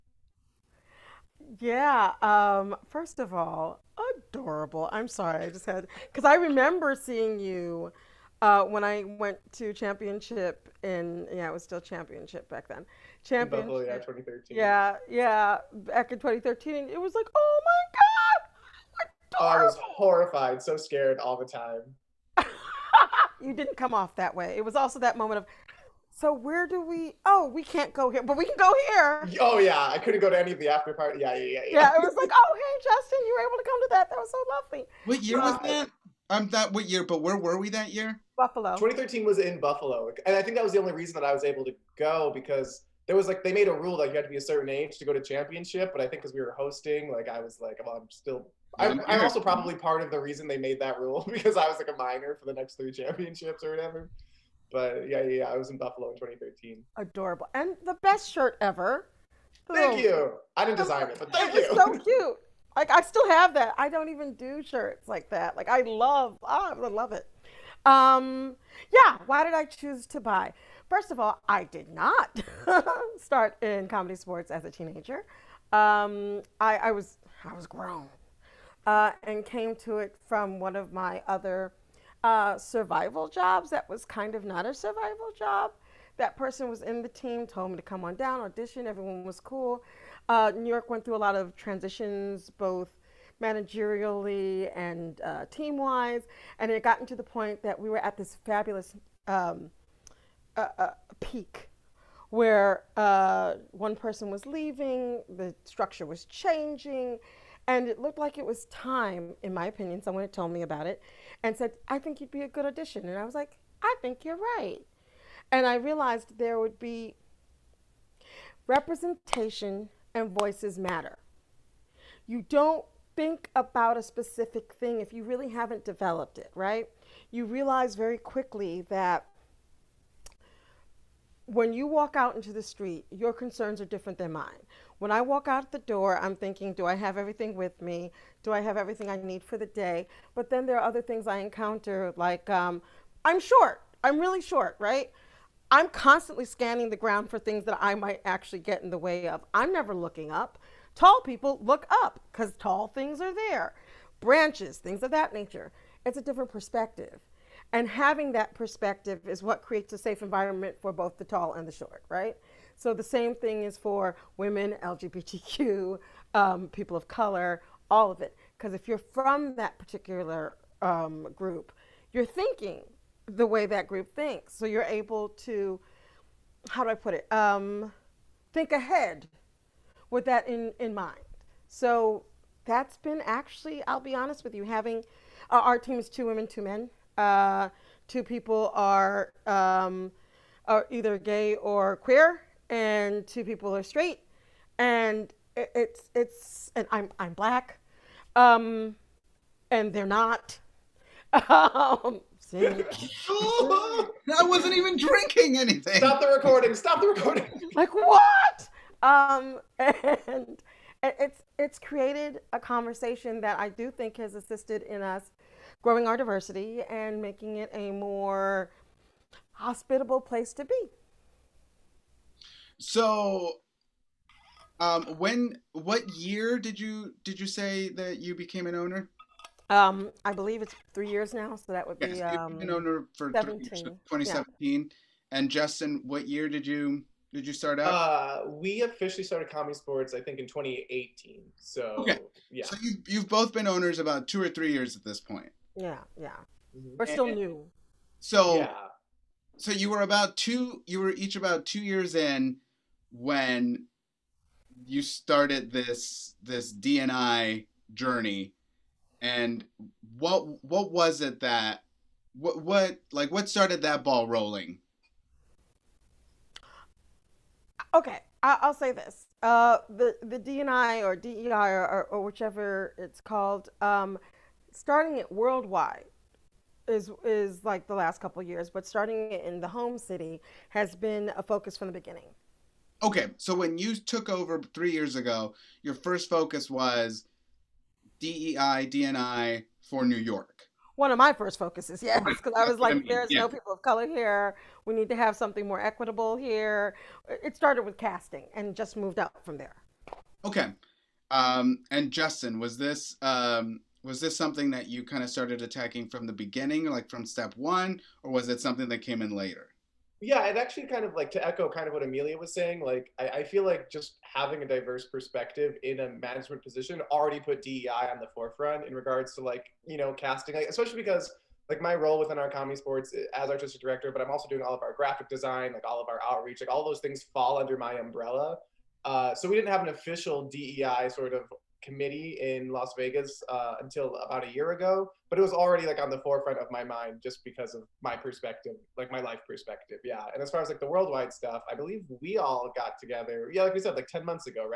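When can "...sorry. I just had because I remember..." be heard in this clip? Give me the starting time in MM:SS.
00:05.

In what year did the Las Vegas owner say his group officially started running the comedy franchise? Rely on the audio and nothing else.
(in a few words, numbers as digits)
2018.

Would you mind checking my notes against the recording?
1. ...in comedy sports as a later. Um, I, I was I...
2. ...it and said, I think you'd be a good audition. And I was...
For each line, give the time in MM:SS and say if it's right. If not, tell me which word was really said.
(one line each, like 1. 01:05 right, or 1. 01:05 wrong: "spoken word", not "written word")
1. 01:13 wrong: "teenager", not "later"
2. 01:50 right.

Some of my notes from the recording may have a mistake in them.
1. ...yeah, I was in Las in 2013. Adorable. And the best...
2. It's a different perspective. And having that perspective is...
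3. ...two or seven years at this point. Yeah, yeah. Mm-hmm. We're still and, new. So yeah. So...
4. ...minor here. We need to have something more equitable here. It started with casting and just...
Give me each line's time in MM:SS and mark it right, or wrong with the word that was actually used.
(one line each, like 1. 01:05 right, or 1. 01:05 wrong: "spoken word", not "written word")
1. 00:55 wrong: "Buffalo", not "Las"
2. 02:36 right
3. 04:04 wrong: "three", not "seven"
4. 04:53 wrong: "color", not "minor".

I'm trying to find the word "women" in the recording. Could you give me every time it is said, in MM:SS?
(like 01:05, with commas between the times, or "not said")
02:44, 03:06.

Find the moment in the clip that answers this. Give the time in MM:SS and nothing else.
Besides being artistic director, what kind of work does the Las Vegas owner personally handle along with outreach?
05:24.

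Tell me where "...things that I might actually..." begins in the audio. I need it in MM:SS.
02:27.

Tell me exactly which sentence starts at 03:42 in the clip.
So, um, when what year did you did you say that you became an owner?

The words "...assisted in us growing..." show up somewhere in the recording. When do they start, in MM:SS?
03:34.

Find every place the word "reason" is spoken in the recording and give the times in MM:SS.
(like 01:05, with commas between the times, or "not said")
00:40, 00:50.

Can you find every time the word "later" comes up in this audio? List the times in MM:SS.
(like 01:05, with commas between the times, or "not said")
05:09.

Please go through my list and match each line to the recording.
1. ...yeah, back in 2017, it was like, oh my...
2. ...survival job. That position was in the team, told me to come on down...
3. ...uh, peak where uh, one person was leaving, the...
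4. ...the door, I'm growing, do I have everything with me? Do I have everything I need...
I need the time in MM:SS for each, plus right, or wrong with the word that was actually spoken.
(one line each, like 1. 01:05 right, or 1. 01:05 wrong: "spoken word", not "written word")
1. 00:15 wrong: "2013", not "2017"
2. 01:24 wrong: "person", not "position"
3. 01:40 right
4. 02:15 wrong: "thinking", not "growing".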